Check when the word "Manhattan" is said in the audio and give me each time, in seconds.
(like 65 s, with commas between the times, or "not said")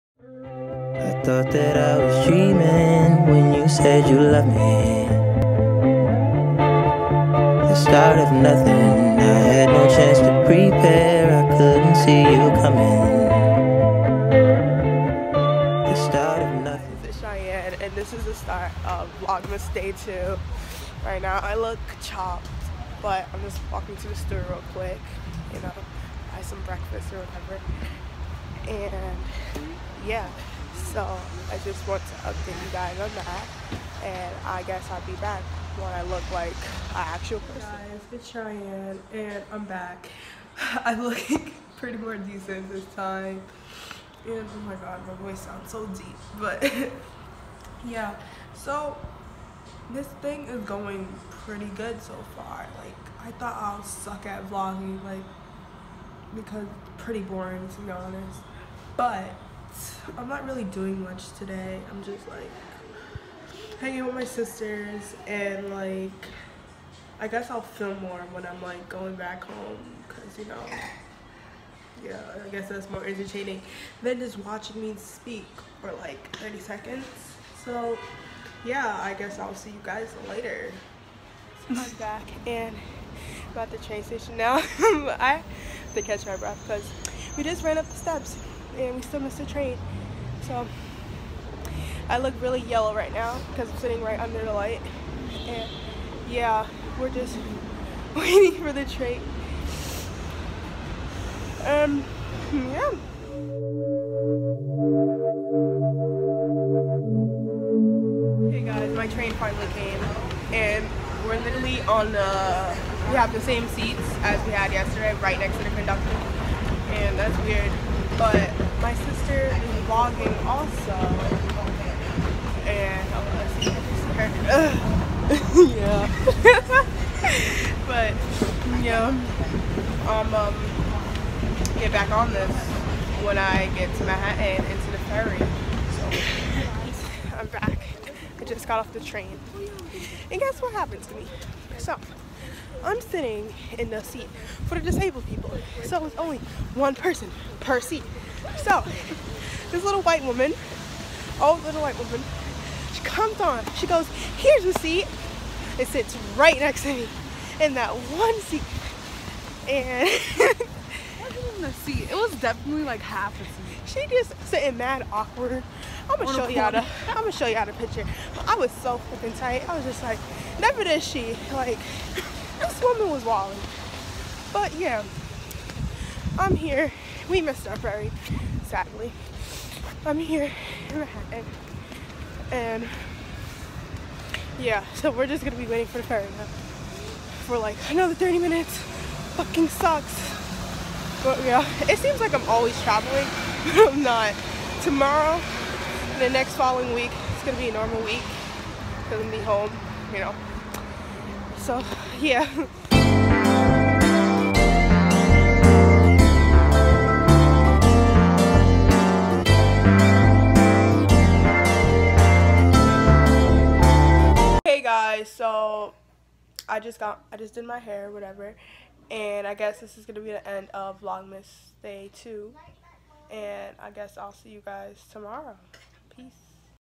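134 s, 180 s.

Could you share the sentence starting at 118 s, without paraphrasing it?
But my sister is vlogging also.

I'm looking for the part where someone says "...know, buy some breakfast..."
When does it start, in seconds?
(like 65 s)
25 s.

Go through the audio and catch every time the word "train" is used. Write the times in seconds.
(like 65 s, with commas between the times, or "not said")
83 s, 89 s, 98 s, 109 s, 138 s.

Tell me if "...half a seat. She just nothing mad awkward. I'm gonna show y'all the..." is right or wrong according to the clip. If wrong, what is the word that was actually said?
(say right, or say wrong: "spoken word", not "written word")
wrong: "sitting", not "nothing".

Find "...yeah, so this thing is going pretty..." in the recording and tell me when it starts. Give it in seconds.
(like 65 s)
47 s.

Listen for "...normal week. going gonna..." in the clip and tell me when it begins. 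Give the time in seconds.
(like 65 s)
197 s.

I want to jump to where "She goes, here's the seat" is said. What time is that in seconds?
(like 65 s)
153 s.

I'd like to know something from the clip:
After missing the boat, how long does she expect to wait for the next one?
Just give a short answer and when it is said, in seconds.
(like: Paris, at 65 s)
30 minutes, at 188 s.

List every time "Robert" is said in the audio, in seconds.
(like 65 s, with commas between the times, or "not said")
not said.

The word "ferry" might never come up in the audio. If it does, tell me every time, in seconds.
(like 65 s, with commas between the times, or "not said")
135 s, 177 s, 186 s.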